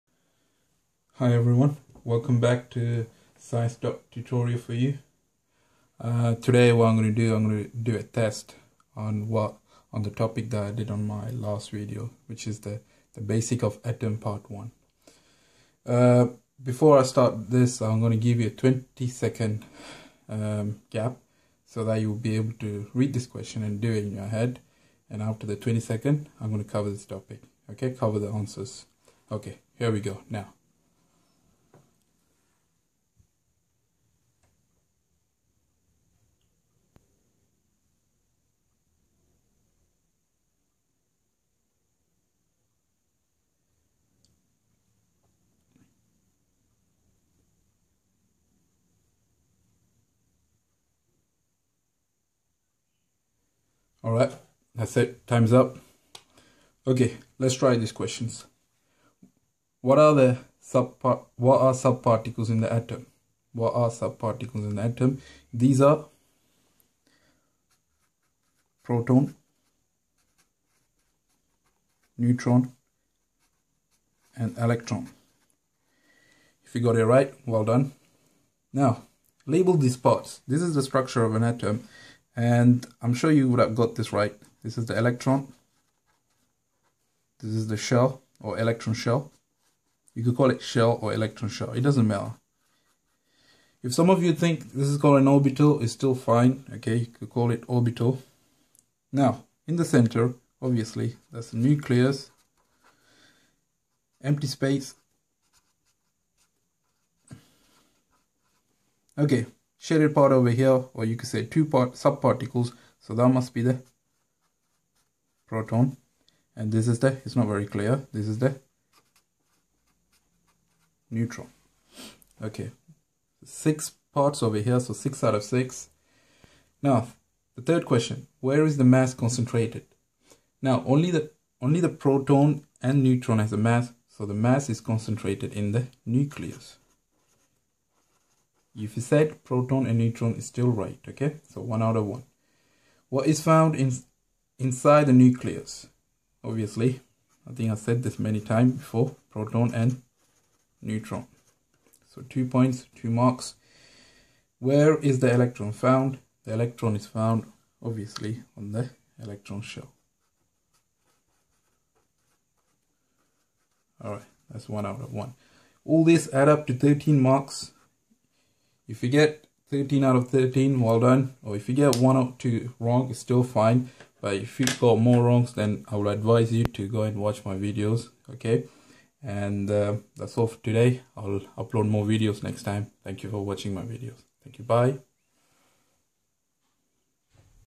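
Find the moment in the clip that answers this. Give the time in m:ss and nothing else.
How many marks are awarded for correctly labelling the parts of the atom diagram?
2:04.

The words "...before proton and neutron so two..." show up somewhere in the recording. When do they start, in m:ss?
2:28.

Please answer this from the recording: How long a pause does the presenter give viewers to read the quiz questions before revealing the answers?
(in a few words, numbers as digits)
20 seconds.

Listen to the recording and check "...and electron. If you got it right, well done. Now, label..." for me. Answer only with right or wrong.
right.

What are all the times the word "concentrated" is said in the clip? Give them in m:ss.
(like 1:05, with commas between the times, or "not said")
2:09, 2:14.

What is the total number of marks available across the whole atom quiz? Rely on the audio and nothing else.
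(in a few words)
13.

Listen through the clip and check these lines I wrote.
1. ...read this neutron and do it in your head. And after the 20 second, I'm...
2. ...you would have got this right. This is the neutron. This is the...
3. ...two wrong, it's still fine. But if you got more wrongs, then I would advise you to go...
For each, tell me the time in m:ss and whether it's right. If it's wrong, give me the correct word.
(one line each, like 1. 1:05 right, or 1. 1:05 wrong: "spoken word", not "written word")
1. 0:22 wrong: "question", not "neutron"
2. 1:23 wrong: "electron", not "neutron"
3. 2:52 right.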